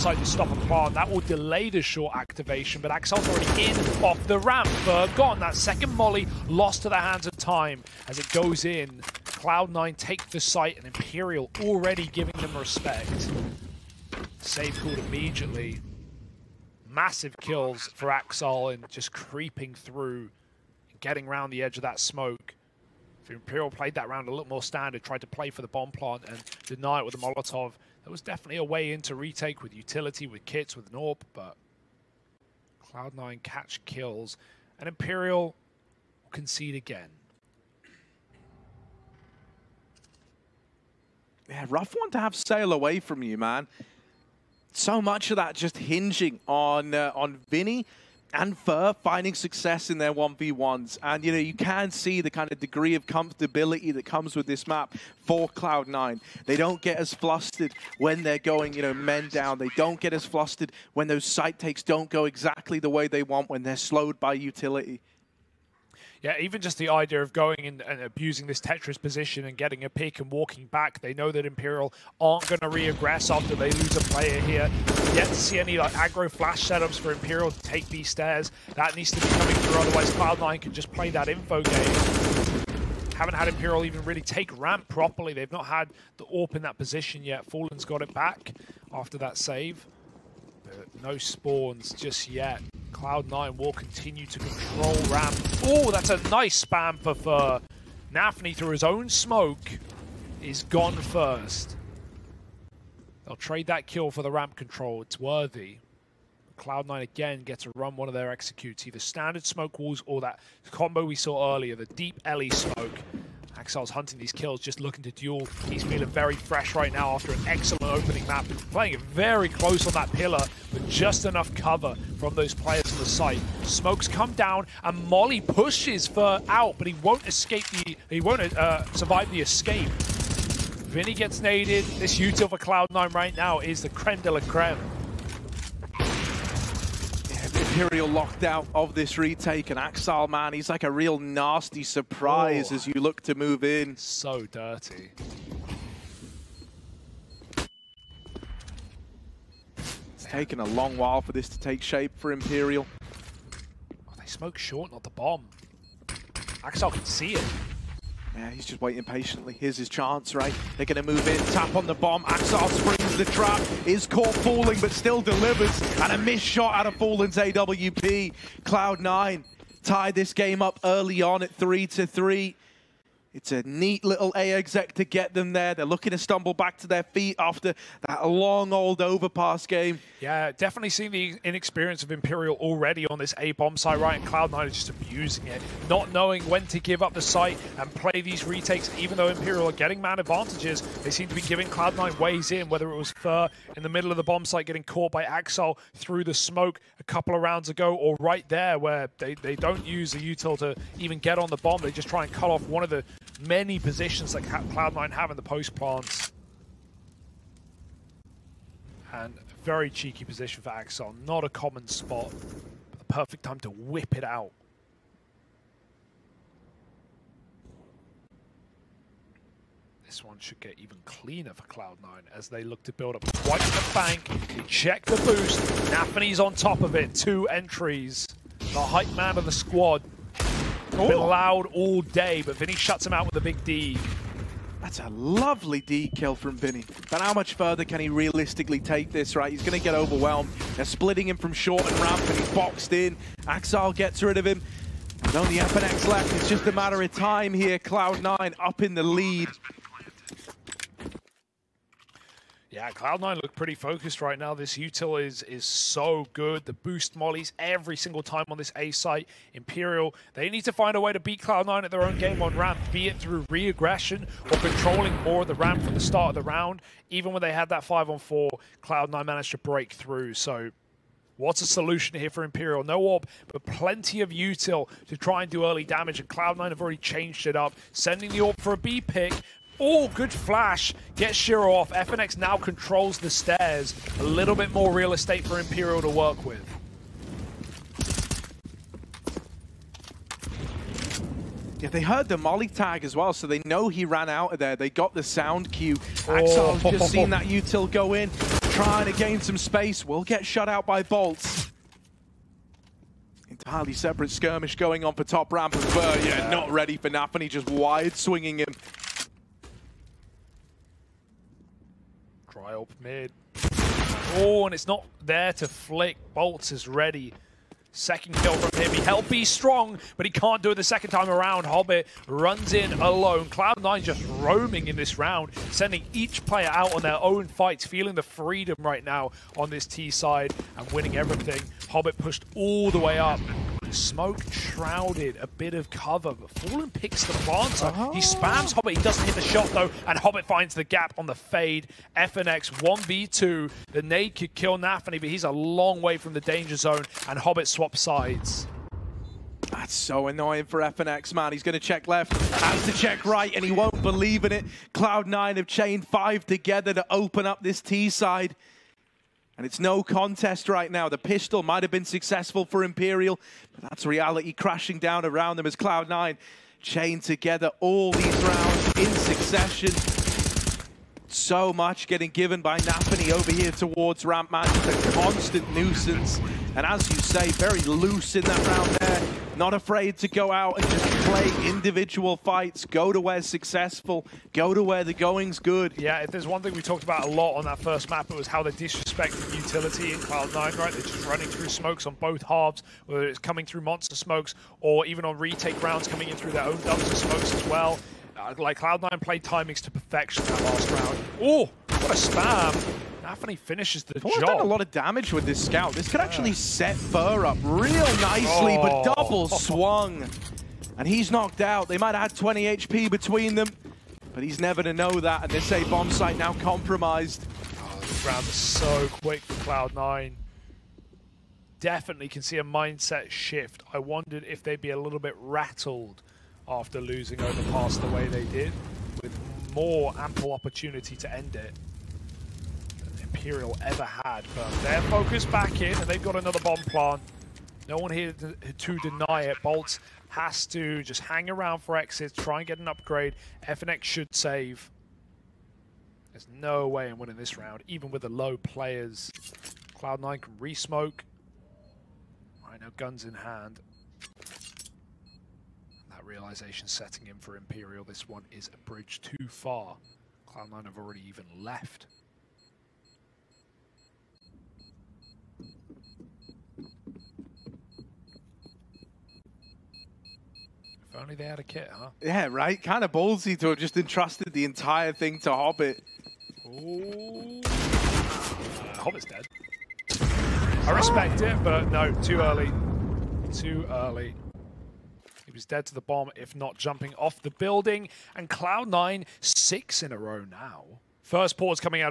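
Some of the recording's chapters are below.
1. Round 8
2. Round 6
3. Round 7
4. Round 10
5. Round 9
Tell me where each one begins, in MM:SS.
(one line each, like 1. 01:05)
1. 04:02
2. 01:21
3. 03:09
4. 07:55
5. 06:17.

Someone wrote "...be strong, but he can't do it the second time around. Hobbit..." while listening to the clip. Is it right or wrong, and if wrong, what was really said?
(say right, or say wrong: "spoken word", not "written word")
right.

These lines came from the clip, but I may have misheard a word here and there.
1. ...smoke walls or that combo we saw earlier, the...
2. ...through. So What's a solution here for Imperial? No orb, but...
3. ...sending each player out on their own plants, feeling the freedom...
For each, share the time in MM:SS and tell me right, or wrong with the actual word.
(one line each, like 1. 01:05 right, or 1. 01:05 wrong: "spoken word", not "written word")
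1. 01:49 right
2. 04:29 right
3. 05:25 wrong: "fights", not "plants".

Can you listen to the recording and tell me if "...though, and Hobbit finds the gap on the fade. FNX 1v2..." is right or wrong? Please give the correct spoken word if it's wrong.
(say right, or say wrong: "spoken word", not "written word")
right.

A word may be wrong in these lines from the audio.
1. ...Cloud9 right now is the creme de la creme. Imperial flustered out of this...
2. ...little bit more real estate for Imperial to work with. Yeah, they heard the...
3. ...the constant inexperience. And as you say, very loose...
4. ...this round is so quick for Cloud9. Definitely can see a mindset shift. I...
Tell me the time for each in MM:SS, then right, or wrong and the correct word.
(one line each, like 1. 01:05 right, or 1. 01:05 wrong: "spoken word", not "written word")
1. 02:12 wrong: "locked", not "flustered"
2. 04:44 right
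3. 06:14 wrong: "nuisance", not "inexperience"
4. 06:57 right.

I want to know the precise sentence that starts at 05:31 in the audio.
Hobbit pushed all the way up.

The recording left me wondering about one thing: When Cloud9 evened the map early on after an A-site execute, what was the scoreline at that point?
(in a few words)
3 to 3.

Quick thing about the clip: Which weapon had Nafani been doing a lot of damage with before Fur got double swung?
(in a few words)
Scout.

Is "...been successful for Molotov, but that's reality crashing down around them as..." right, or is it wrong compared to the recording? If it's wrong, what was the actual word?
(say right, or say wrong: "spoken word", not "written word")
wrong: "Imperial", not "Molotov".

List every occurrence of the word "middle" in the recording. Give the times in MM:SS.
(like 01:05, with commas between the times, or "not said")
03:13.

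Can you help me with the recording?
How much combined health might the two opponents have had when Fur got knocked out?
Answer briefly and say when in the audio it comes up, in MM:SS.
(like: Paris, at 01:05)
20 HP, at 06:52.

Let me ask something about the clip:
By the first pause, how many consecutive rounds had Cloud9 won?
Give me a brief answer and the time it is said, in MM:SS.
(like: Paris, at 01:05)
6, at 08:09.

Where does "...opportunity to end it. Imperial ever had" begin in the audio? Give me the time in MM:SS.
07:10.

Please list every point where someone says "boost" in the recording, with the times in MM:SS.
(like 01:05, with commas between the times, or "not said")
03:45, 04:16.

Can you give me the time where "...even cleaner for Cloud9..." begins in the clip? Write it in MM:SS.
03:40.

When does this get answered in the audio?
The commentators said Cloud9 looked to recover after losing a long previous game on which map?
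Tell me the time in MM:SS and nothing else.
02:58.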